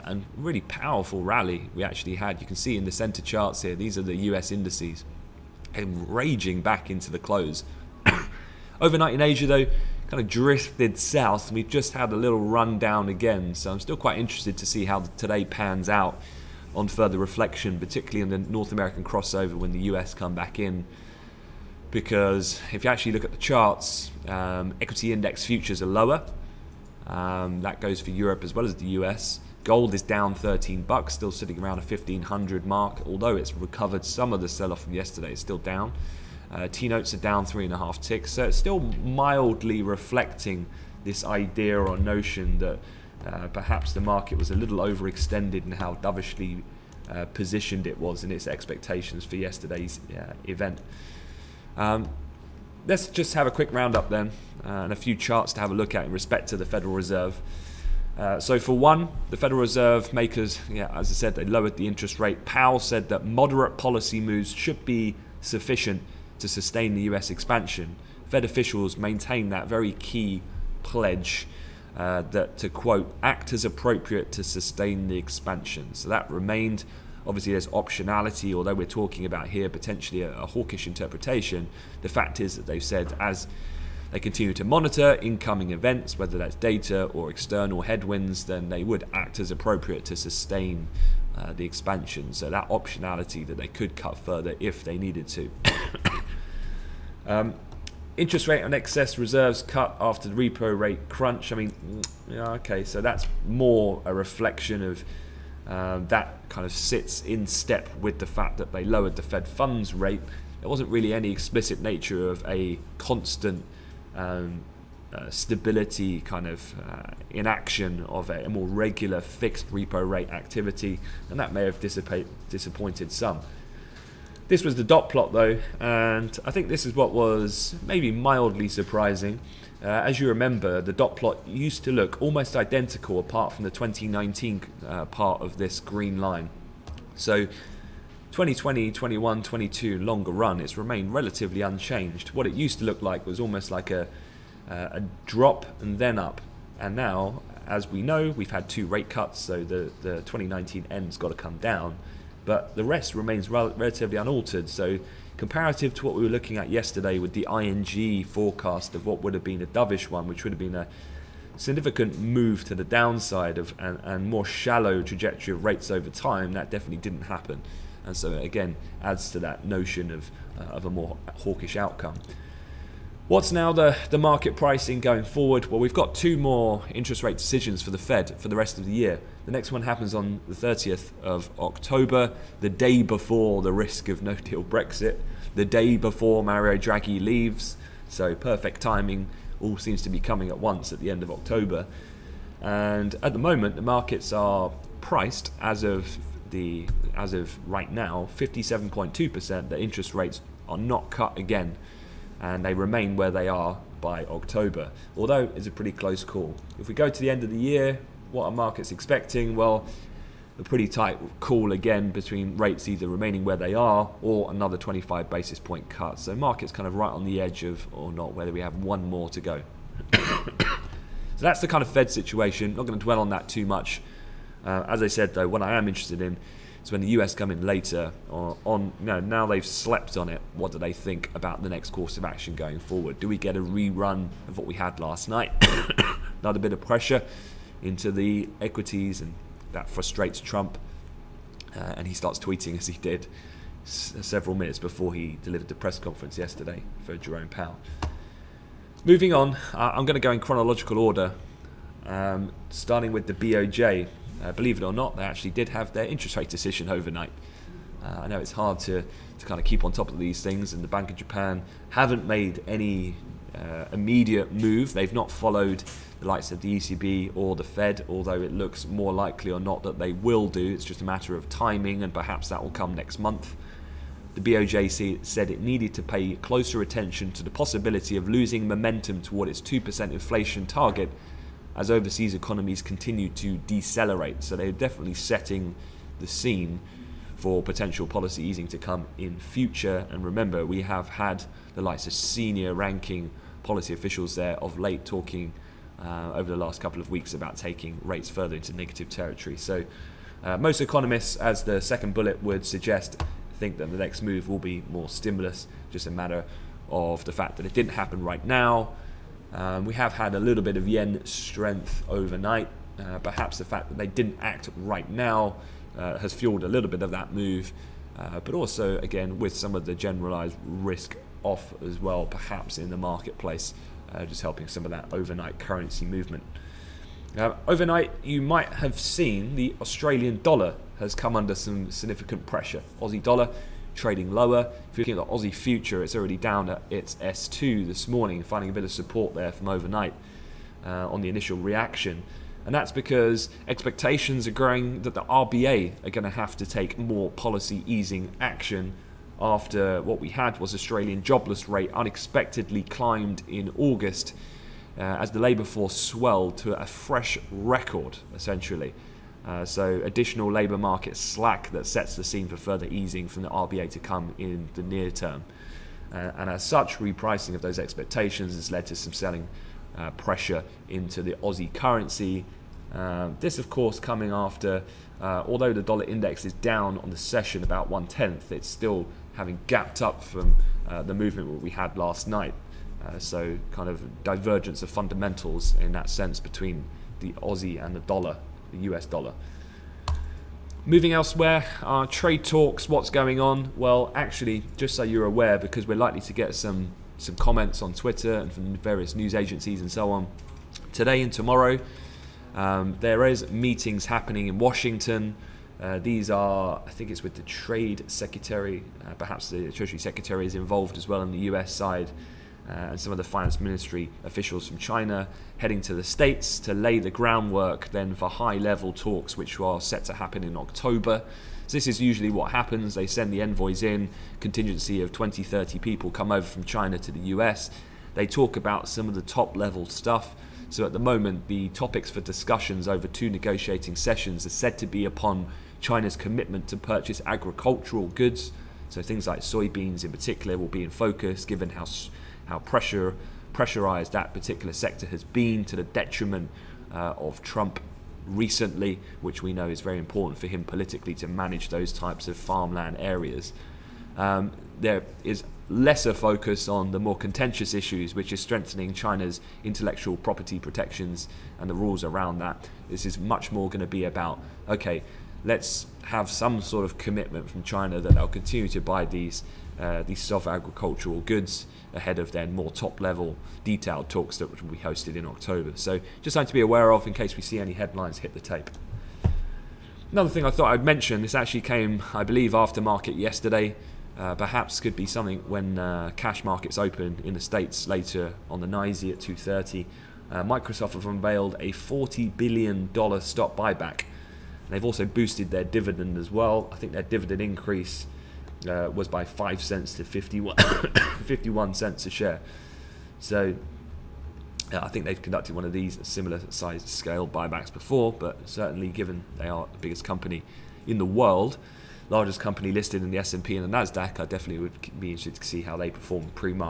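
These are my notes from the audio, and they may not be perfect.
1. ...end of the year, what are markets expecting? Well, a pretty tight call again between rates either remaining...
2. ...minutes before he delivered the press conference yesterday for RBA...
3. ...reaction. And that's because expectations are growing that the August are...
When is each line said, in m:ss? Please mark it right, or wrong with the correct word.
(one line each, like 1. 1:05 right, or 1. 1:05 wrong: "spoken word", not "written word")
1. 3:27 right
2. 4:04 wrong: "Jerome", not "RBA"
3. 5:41 wrong: "RBA", not "August".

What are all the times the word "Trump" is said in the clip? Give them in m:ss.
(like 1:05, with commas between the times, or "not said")
4:00, 7:27.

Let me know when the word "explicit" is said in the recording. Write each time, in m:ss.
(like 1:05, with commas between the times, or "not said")
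1:51.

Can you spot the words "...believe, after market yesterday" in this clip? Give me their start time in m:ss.
8:02.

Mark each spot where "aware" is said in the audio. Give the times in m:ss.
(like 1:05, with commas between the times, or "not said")
6:35, 7:56.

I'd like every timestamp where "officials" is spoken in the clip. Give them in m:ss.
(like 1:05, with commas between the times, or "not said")
1:08, 4:53, 6:54.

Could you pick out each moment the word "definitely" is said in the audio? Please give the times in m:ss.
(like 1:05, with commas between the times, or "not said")
2:46, 4:44, 8:34.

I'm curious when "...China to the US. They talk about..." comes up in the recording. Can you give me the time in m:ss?
7:06.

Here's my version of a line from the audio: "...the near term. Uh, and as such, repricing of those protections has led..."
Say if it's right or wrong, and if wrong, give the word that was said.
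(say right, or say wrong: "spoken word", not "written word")
wrong: "expectations", not "protections".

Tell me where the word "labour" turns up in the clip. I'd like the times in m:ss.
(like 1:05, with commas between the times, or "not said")
5:55, 6:00.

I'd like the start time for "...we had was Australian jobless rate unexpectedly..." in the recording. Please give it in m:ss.
5:50.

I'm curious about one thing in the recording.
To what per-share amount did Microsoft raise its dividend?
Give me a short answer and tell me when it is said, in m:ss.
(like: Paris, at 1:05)
51 cents, at 8:21.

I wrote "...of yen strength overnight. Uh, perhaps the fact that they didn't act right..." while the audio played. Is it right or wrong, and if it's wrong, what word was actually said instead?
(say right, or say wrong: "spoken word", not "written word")
right.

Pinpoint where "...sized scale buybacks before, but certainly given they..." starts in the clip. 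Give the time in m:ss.
8:26.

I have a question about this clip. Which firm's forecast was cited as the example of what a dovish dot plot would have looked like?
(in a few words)
ING.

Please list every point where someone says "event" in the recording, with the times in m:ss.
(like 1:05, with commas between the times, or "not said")
0:50, 1:25.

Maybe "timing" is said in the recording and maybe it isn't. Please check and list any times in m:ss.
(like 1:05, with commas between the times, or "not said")
3:08, 4:31.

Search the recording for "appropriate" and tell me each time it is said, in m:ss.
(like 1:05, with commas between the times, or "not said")
1:13, 1:29.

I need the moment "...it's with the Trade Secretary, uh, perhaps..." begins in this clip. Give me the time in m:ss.
6:47.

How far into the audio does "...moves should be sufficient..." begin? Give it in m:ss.
1:04.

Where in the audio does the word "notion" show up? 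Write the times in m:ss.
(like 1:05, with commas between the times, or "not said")
0:41, 2:49.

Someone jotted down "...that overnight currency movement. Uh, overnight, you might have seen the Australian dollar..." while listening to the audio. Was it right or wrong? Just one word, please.
right.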